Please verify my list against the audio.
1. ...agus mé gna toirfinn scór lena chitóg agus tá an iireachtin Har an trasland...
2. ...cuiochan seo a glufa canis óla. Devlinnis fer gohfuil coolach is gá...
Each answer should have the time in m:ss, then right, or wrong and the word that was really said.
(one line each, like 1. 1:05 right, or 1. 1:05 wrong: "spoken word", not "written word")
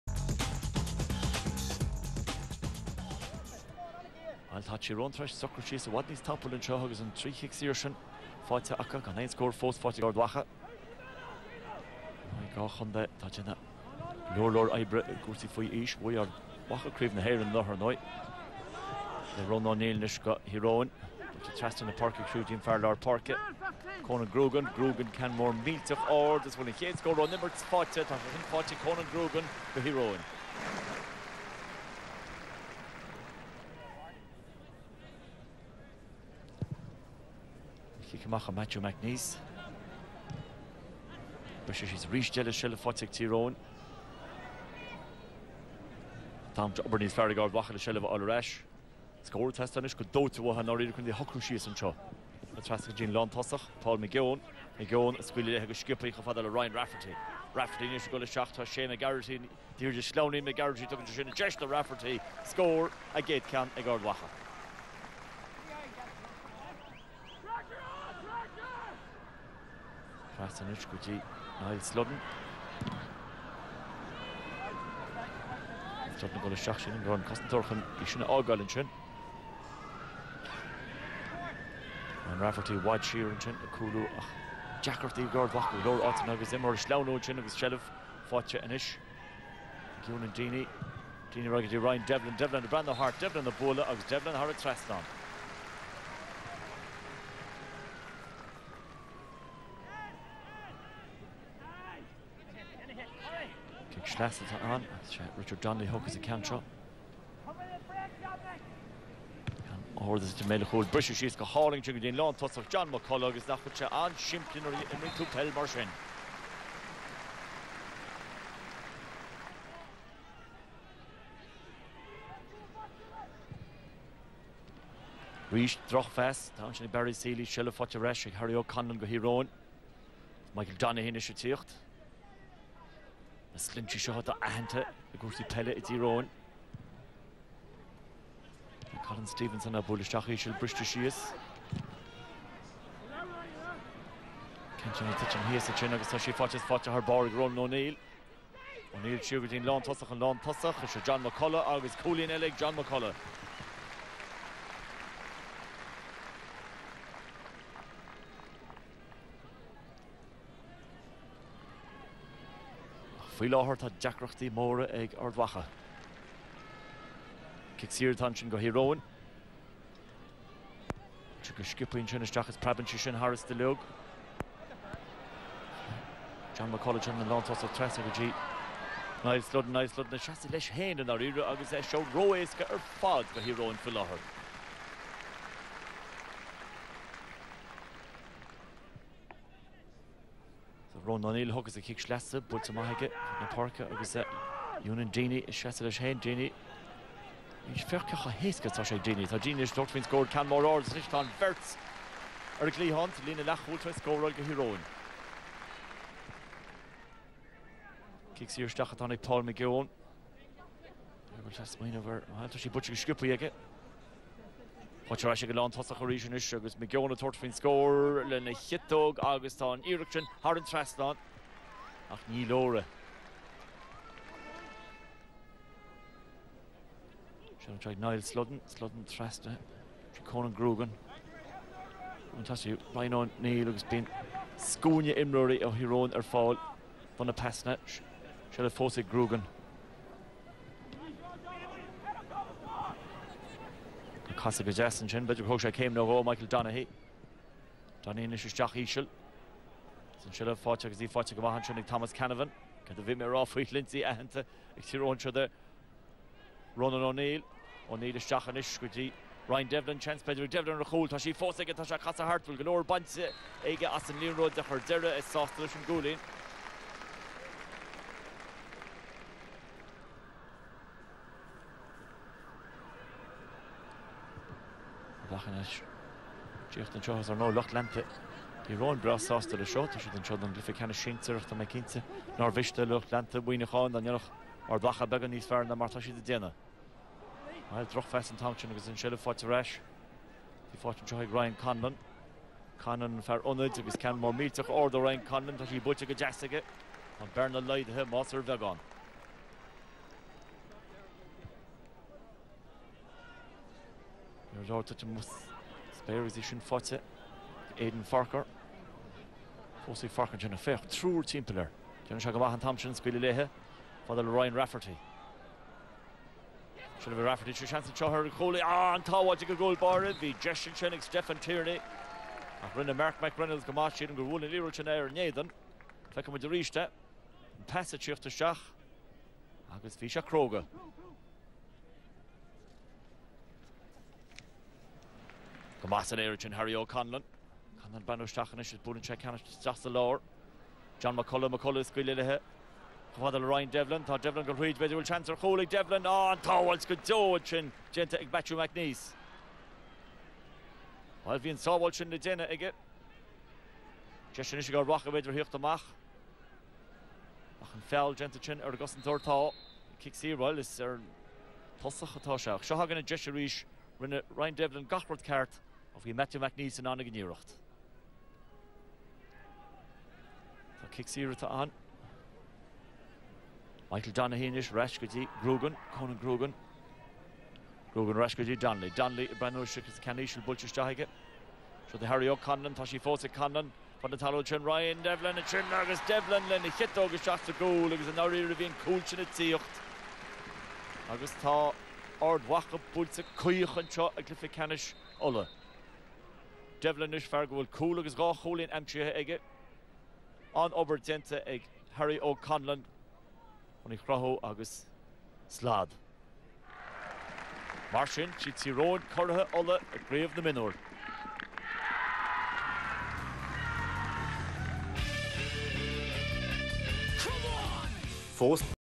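1. 3:36 right
2. 6:33 right.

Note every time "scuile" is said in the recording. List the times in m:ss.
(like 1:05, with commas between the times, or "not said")
5:12, 5:41.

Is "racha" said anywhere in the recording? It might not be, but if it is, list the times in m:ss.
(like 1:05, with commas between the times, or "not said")
5:54.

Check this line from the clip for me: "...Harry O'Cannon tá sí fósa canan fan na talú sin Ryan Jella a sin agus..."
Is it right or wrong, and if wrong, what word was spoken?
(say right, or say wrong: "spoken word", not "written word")
wrong: "Devlin", not "Jella".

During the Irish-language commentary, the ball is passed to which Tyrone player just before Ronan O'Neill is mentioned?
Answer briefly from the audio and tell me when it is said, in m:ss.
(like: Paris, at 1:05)
Thomas Canavan, at 4:11.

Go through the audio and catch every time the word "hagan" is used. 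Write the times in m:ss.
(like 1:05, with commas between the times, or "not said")
6:02.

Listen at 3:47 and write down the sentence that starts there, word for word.
Se treid Niall Sludden Sludden treste Conan grúgan.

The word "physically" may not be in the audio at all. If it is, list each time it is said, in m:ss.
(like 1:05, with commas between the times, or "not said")
not said.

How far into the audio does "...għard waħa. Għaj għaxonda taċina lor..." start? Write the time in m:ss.
0:10.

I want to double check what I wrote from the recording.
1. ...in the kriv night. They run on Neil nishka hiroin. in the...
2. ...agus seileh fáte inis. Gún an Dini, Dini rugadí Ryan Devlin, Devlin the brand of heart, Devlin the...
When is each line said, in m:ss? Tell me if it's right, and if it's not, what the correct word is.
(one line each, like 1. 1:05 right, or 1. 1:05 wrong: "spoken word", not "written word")
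1. 0:17 right
2. 1:27 right.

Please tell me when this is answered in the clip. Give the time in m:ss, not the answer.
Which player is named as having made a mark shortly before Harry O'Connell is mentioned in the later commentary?
5:21.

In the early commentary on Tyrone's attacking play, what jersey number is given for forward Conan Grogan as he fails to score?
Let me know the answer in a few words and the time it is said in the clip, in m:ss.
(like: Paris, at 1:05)
40, at 0:27.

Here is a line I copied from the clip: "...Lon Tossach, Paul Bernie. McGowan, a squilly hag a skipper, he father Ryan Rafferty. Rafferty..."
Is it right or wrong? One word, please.
wrong.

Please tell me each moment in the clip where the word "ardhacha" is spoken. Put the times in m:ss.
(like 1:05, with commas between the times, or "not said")
2:45, 6:32.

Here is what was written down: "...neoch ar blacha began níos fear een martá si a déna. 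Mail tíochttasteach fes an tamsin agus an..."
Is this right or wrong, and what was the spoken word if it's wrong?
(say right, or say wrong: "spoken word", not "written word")
wrong: "droch", not "tíochttasteach".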